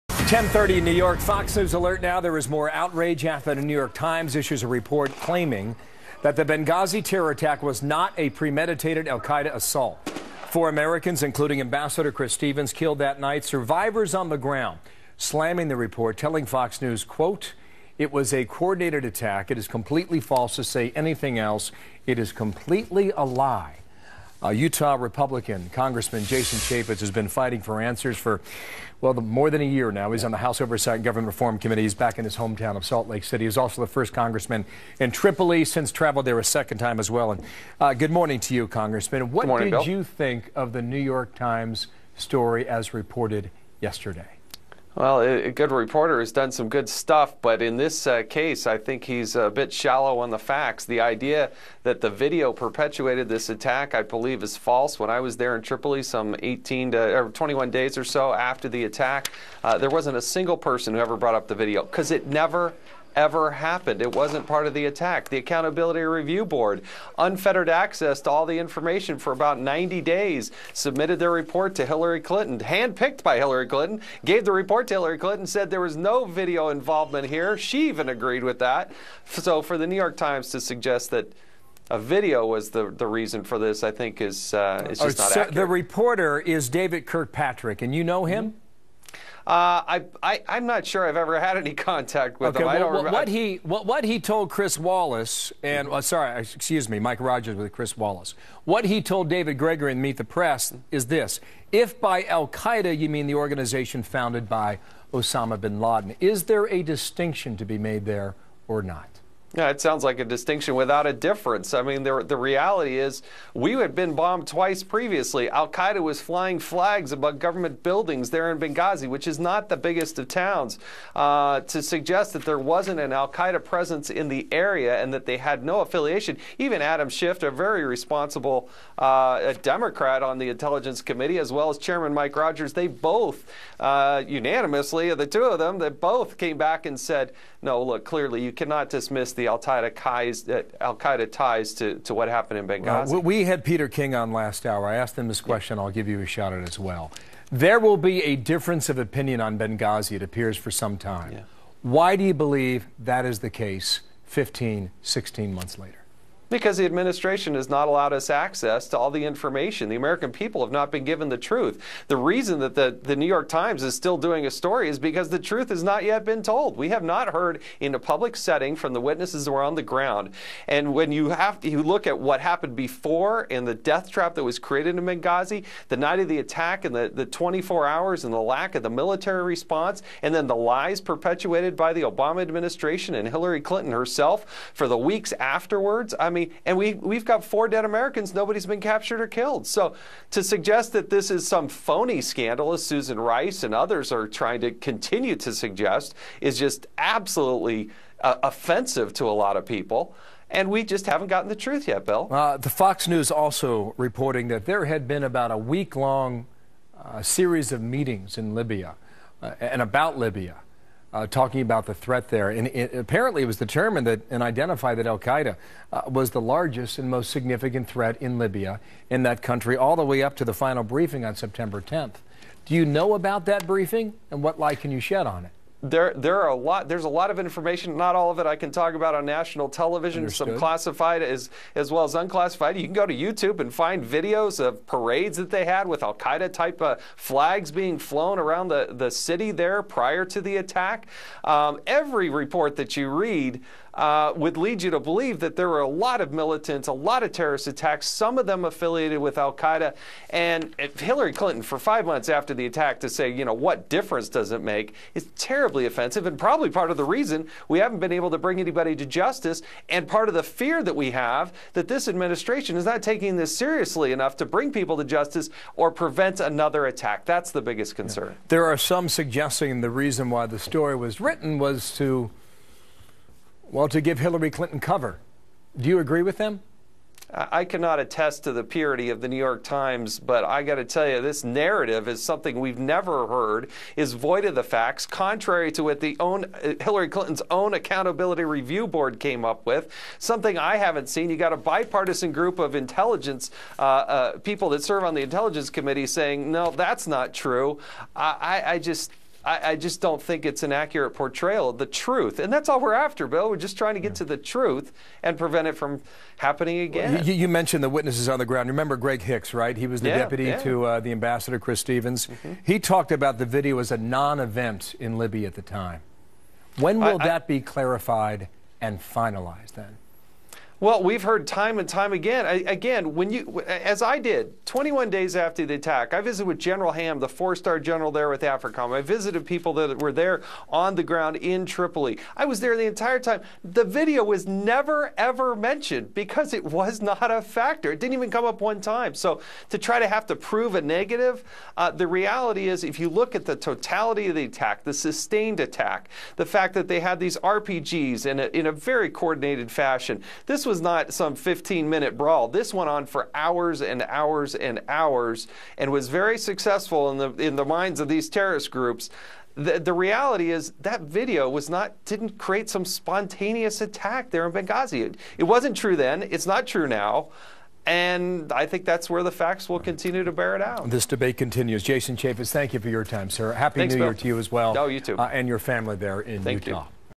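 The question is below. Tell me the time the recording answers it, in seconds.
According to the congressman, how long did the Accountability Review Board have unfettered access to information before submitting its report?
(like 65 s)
69 s.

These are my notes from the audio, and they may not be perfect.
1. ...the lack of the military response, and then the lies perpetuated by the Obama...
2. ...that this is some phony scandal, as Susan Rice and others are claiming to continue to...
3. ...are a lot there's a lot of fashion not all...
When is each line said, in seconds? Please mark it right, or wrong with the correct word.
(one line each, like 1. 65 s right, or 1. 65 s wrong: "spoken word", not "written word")
1. 178 s right
2. 190 s wrong: "trying", not "claiming"
3. 226 s wrong: "information", not "fashion".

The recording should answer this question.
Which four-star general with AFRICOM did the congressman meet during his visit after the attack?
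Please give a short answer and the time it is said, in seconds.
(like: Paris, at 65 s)
General Ham, at 326 s.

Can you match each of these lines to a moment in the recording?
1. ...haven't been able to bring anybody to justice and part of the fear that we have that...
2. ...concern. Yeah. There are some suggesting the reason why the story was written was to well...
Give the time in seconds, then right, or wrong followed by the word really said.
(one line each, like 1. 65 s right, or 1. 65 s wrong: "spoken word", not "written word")
1. 257 s right
2. 267 s right.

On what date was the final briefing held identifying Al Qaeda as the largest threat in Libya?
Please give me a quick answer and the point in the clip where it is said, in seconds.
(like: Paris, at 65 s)
September 10th, at 221 s.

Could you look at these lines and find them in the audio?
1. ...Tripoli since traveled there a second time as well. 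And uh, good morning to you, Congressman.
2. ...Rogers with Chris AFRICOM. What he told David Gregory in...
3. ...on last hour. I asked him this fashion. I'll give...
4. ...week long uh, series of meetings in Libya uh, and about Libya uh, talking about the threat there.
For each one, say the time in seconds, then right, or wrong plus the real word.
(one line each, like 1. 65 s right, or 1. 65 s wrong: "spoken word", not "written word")
1. 35 s right
2. 97 s wrong: "Wallace", not "AFRICOM"
3. 144 s wrong: "question", not "fashion"
4. 205 s right.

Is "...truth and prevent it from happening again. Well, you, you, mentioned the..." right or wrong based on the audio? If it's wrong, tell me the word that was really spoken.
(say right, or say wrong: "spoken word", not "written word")
right.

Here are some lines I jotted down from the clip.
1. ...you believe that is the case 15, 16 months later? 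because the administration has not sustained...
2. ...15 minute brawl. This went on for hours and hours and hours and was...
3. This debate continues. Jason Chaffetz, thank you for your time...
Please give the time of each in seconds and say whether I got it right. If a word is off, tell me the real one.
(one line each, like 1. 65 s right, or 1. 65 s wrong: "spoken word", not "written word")
1. 152 s wrong: "allowed", not "sustained"
2. 351 s right
3. 370 s right.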